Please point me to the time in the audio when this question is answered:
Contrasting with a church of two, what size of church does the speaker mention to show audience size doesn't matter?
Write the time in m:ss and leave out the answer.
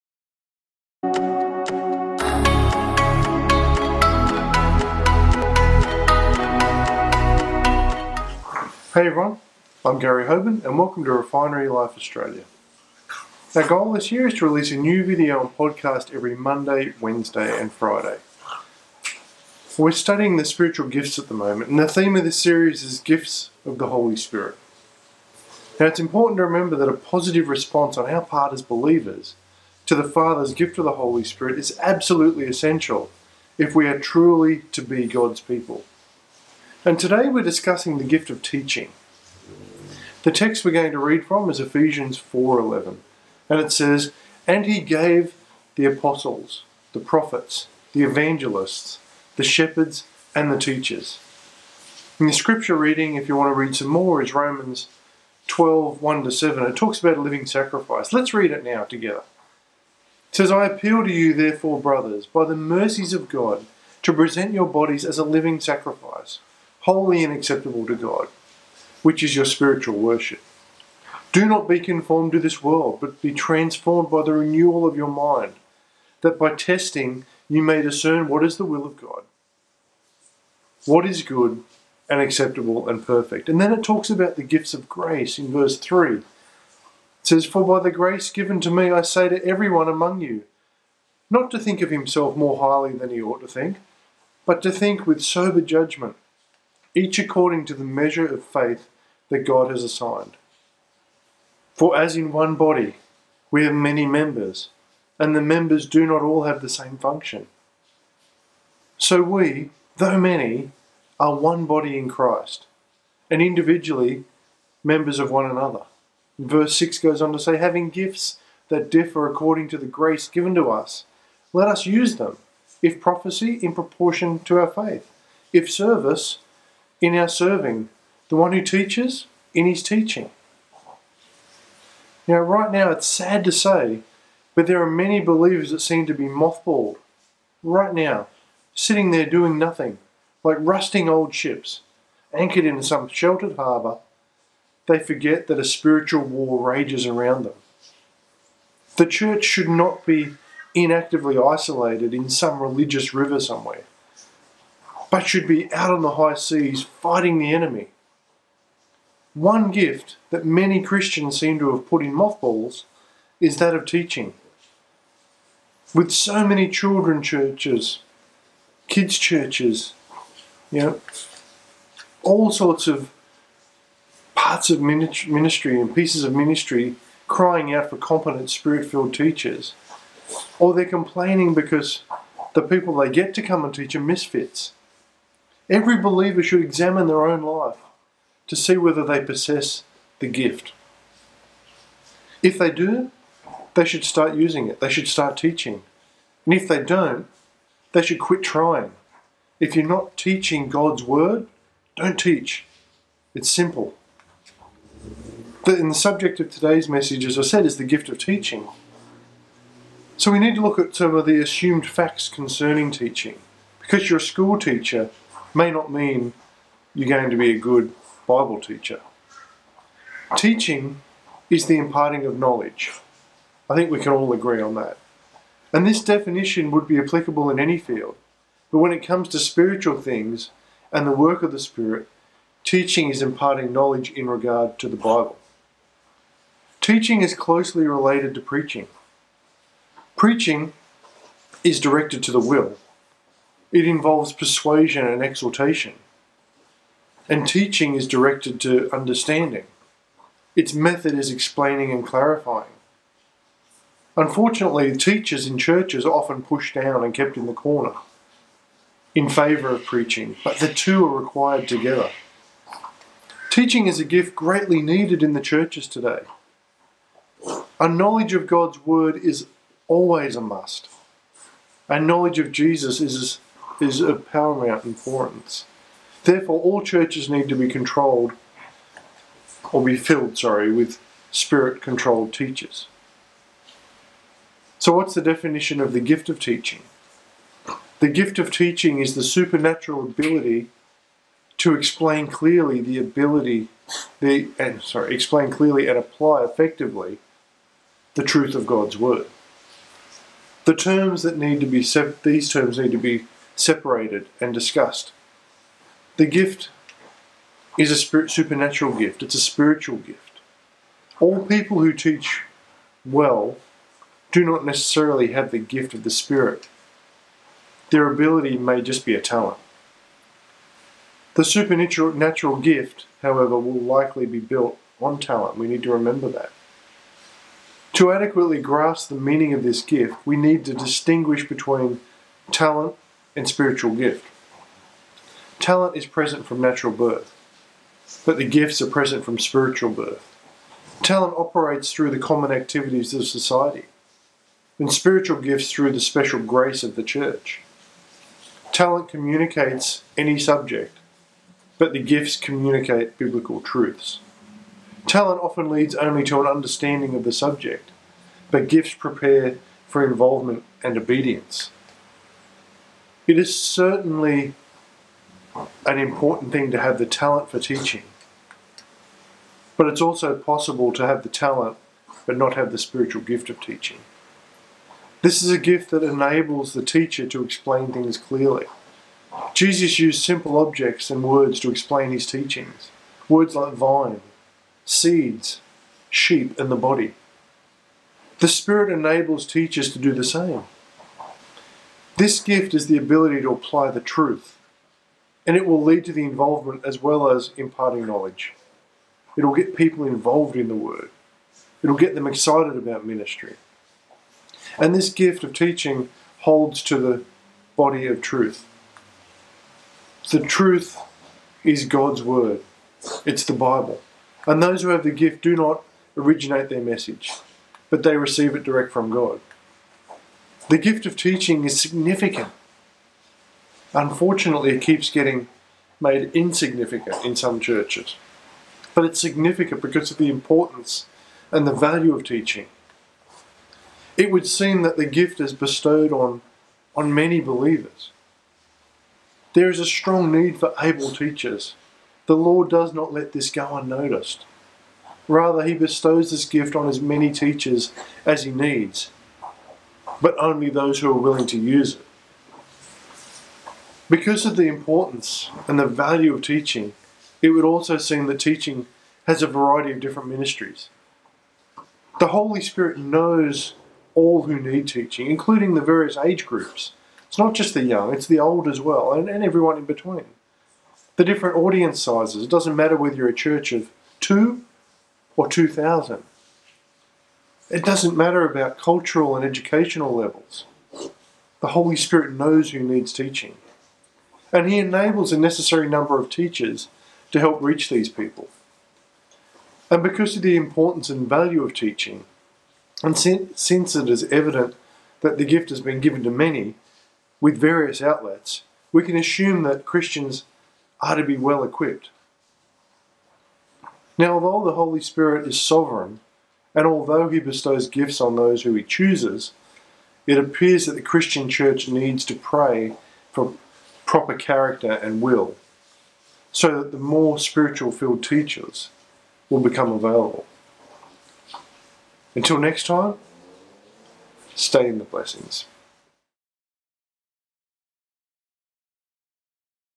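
7:55.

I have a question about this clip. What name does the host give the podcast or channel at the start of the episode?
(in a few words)
Refinery Life Australia.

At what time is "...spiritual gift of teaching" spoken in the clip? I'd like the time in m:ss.
6:12.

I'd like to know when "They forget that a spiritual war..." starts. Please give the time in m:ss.
2:24.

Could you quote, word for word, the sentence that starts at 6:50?
The truth is God's Word, it's the Bible.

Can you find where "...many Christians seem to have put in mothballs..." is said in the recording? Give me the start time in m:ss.
2:40.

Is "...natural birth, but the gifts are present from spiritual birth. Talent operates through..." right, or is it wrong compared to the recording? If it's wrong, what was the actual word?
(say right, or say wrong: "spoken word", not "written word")
right.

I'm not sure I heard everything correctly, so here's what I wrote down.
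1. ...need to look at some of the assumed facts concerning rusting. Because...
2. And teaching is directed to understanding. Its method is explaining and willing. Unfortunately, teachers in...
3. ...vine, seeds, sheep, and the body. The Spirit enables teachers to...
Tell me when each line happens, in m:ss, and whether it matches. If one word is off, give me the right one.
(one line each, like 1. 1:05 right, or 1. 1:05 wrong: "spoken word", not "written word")
1. 3:30 wrong: "teaching", not "rusting"
2. 4:07 wrong: "clarifying", not "willing"
3. 6:23 right.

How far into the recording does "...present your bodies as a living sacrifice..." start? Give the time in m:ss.
1:04.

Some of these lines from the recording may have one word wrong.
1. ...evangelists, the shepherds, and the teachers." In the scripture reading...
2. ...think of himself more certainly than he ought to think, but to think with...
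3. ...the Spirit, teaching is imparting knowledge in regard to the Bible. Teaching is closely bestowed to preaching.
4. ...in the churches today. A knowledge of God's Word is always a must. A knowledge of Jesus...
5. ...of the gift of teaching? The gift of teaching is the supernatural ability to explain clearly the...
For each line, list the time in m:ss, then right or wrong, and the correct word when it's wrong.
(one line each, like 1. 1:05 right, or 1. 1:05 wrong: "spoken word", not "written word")
1. 0:48 right
2. 1:31 wrong: "highly", not "certainly"
3. 3:51 wrong: "related", not "bestowed"
4. 4:25 right
5. 4:45 right.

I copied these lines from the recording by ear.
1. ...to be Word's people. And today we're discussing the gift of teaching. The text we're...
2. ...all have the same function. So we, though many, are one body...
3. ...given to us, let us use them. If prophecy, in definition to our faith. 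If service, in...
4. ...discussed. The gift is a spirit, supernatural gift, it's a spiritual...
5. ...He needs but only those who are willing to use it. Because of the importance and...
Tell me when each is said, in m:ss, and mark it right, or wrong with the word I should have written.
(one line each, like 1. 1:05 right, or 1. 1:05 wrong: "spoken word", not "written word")
1. 0:34 wrong: "God", not "Word"
2. 1:46 right
3. 2:00 wrong: "proportion", not "definition"
4. 5:04 right
5. 7:28 right.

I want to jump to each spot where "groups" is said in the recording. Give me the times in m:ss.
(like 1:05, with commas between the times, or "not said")
7:46.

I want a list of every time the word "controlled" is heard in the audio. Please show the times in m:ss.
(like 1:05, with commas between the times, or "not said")
4:37, 4:41.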